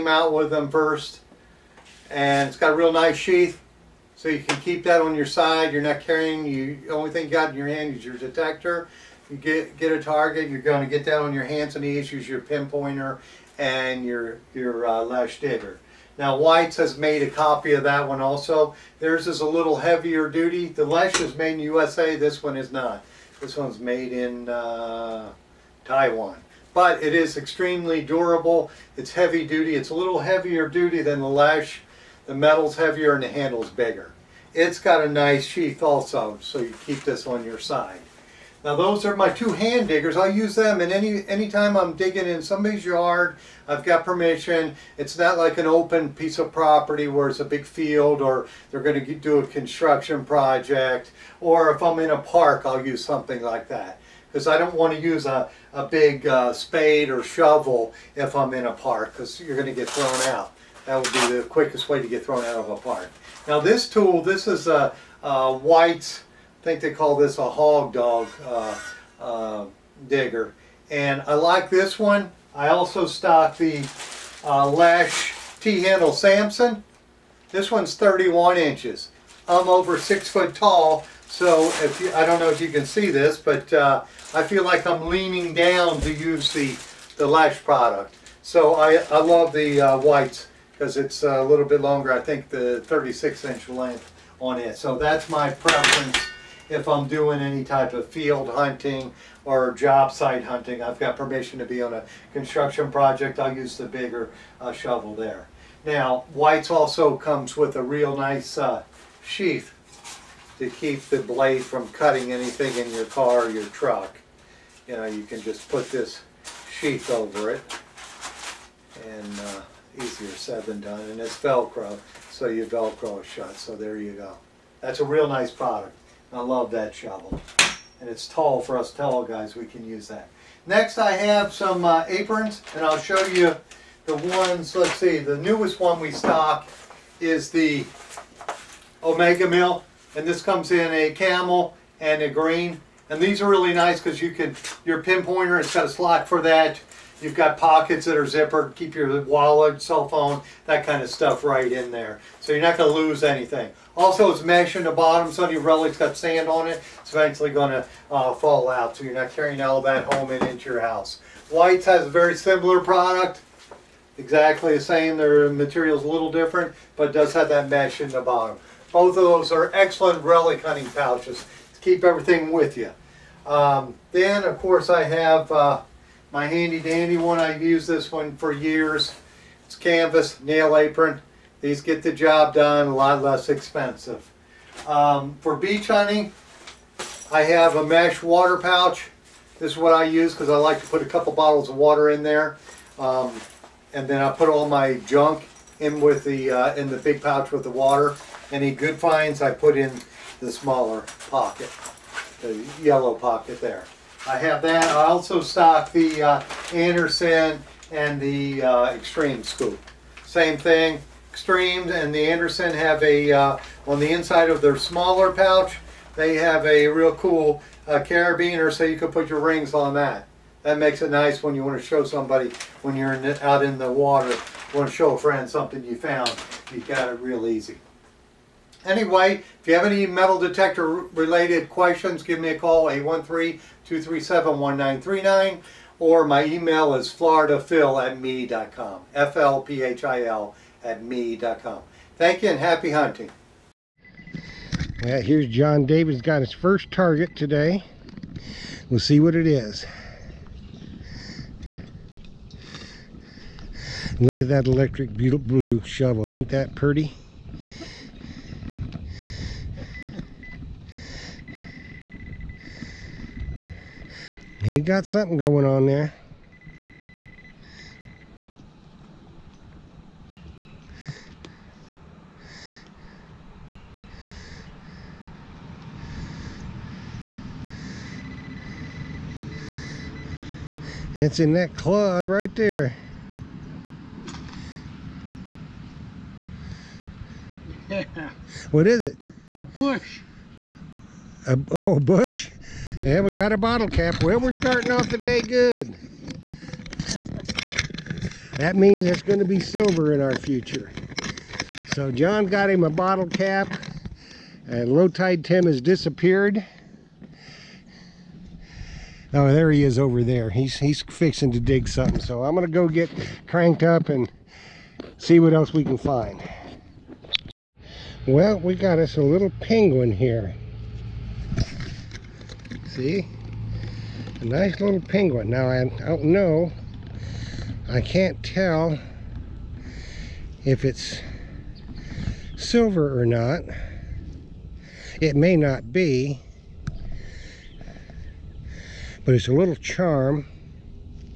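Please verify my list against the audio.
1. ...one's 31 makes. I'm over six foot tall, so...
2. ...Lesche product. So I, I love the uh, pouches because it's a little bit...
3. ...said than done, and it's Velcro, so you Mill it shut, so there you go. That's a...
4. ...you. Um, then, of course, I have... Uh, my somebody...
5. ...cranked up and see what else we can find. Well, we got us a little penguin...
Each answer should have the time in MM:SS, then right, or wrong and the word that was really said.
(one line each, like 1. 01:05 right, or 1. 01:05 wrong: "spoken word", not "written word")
1. 01:17 wrong: "inches", not "makes"
2. 01:27 wrong: "whites", not "pouches"
3. 02:00 wrong: "Velcro", not "Mill"
4. 02:52 wrong: "handy", not "somebody"
5. 05:13 right.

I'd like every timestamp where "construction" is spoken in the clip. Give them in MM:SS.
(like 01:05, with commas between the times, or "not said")
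00:49, 01:42.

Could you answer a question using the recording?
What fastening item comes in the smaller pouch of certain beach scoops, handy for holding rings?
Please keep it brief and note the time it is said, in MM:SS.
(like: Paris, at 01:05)
carabiner, at 03:37.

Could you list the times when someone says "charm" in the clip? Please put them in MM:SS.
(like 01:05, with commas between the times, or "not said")
05:39.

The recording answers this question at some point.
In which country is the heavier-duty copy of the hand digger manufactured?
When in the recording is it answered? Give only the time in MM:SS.
00:25.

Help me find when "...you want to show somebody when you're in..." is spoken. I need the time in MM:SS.
03:41.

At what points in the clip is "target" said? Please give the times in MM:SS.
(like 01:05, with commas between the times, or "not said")
00:10, 04:06.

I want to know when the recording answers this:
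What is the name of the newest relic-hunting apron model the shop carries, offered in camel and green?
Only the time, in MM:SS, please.
02:19.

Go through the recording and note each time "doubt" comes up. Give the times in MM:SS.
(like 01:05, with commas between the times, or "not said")
not said.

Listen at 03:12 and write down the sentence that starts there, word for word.
Um, and then I put all my junk in with the uh, in the big pouch with the water.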